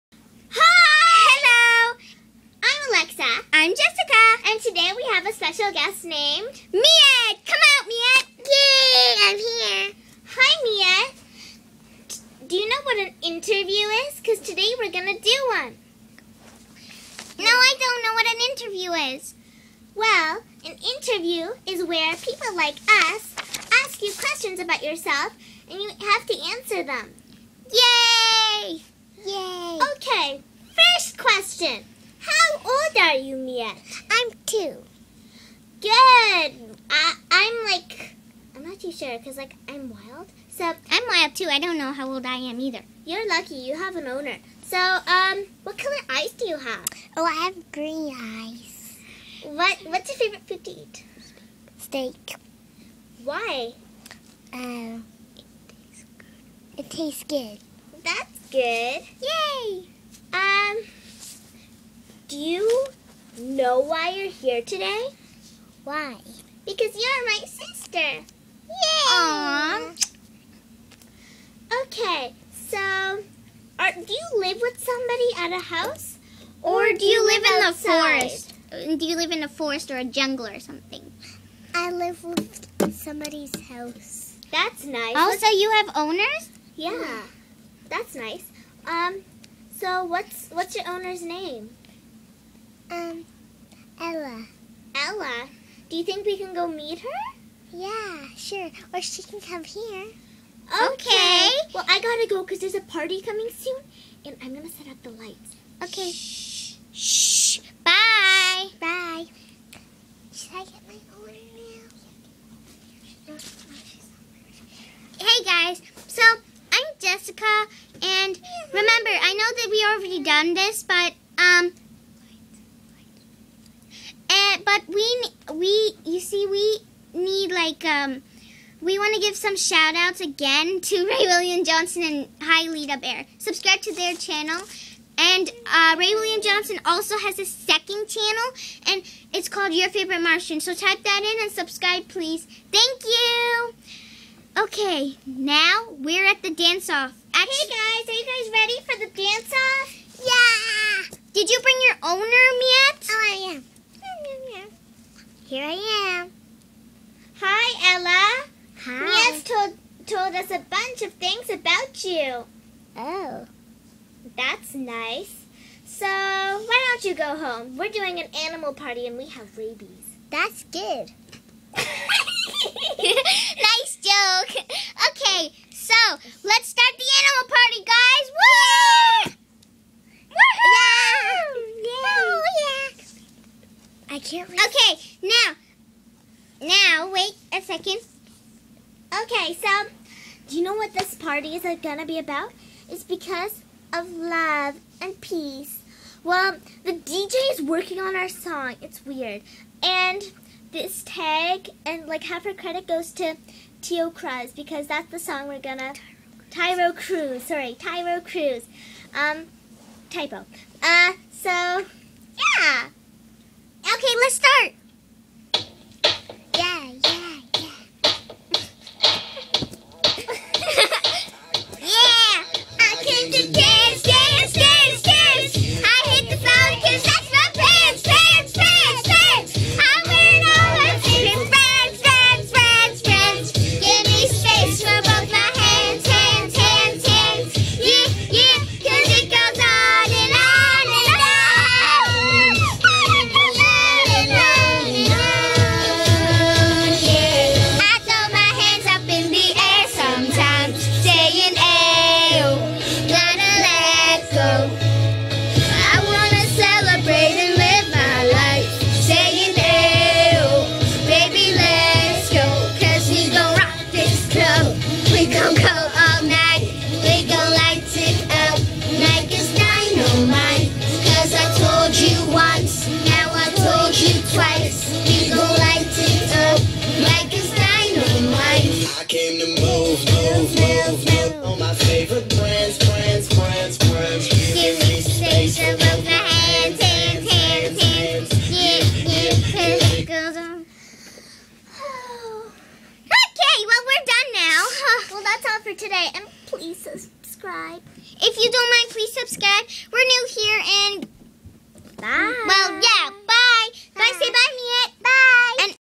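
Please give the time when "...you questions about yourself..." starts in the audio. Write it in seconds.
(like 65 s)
24 s.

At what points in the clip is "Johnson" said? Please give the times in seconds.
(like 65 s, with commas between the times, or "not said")
131 s, 136 s.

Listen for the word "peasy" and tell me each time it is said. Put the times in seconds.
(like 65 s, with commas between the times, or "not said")
not said.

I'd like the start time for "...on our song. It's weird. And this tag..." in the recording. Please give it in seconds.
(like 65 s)
197 s.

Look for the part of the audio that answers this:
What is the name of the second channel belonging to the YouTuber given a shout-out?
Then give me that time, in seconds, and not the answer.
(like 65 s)
139 s.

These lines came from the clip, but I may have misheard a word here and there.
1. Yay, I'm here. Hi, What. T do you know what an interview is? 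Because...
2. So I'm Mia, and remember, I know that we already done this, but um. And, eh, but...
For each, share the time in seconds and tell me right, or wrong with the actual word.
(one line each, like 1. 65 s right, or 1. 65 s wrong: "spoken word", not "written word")
1. 8 s wrong: "Mia", not "What"
2. 116 s wrong: "Jessica", not "Mia".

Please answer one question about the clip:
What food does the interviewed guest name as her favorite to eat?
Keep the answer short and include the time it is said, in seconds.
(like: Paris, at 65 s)
Steak, at 51 s.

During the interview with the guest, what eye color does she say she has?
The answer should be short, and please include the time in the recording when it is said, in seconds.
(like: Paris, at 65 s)
Green, at 47 s.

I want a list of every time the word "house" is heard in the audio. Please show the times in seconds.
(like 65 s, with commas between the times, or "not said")
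75 s, 83 s.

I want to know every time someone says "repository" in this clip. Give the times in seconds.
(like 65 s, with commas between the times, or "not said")
not said.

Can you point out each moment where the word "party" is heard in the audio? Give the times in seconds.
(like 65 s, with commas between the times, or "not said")
102 s, 168 s, 177 s, 191 s.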